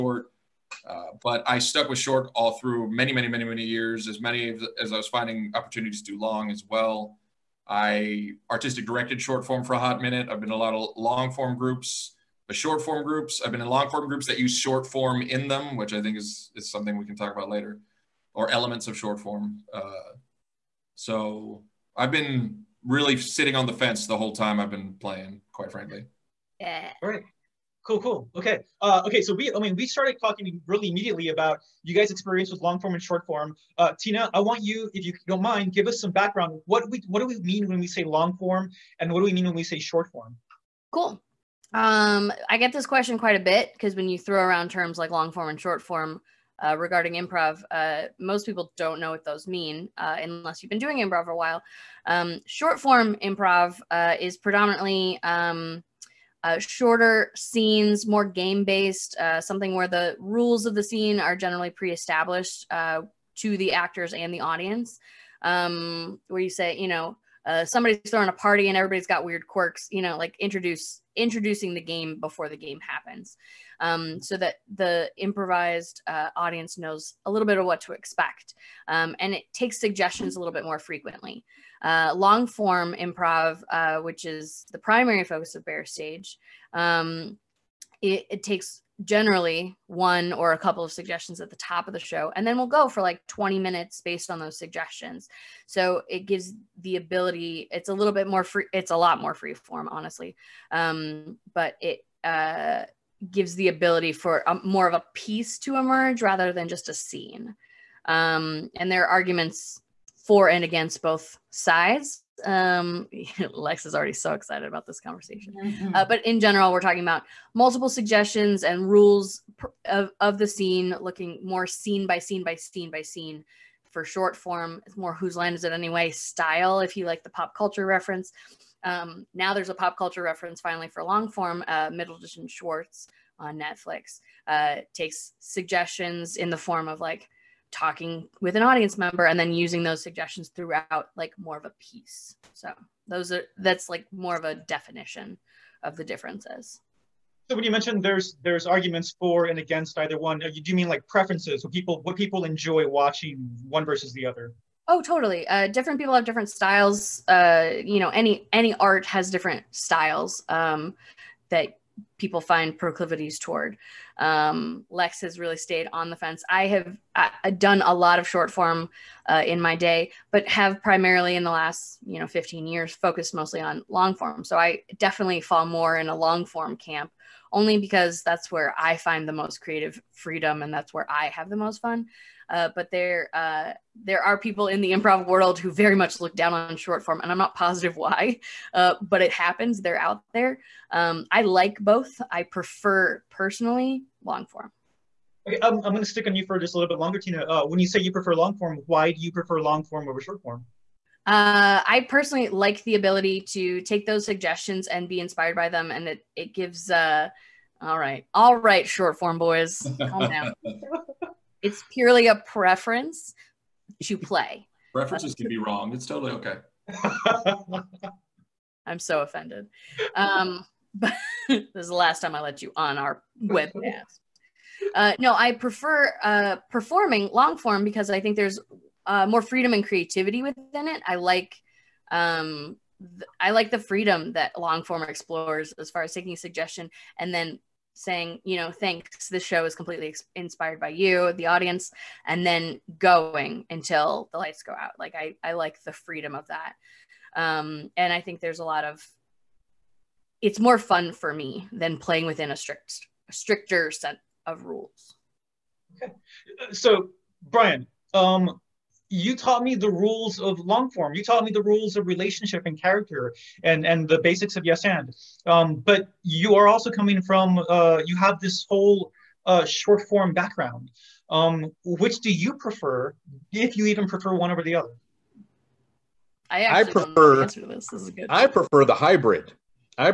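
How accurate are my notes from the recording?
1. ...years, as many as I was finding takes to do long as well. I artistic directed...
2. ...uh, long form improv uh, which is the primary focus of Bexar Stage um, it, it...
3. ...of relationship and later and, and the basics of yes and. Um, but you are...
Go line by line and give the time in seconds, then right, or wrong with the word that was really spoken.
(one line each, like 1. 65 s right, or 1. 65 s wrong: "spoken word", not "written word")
1. 3 s wrong: "opportunities", not "takes"
2. 81 s right
3. 261 s wrong: "character", not "later".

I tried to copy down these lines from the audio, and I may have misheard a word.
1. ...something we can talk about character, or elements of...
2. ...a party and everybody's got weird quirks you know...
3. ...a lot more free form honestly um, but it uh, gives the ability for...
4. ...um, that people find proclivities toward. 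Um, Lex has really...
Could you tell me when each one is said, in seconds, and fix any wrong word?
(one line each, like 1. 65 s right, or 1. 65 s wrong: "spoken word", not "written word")
1. 16 s wrong: "later", not "character"
2. 68 s right
3. 98 s right
4. 160 s right.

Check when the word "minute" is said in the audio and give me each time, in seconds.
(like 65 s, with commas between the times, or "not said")
10 s, 93 s.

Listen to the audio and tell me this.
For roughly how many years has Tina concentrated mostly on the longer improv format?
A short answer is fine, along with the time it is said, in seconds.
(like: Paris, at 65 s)
15, at 172 s.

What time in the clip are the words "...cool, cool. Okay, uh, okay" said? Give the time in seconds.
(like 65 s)
27 s.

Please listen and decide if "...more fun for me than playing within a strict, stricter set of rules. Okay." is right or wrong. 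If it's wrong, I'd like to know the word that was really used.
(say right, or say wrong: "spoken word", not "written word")
right.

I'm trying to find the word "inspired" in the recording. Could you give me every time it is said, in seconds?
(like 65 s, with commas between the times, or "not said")
205 s, 240 s.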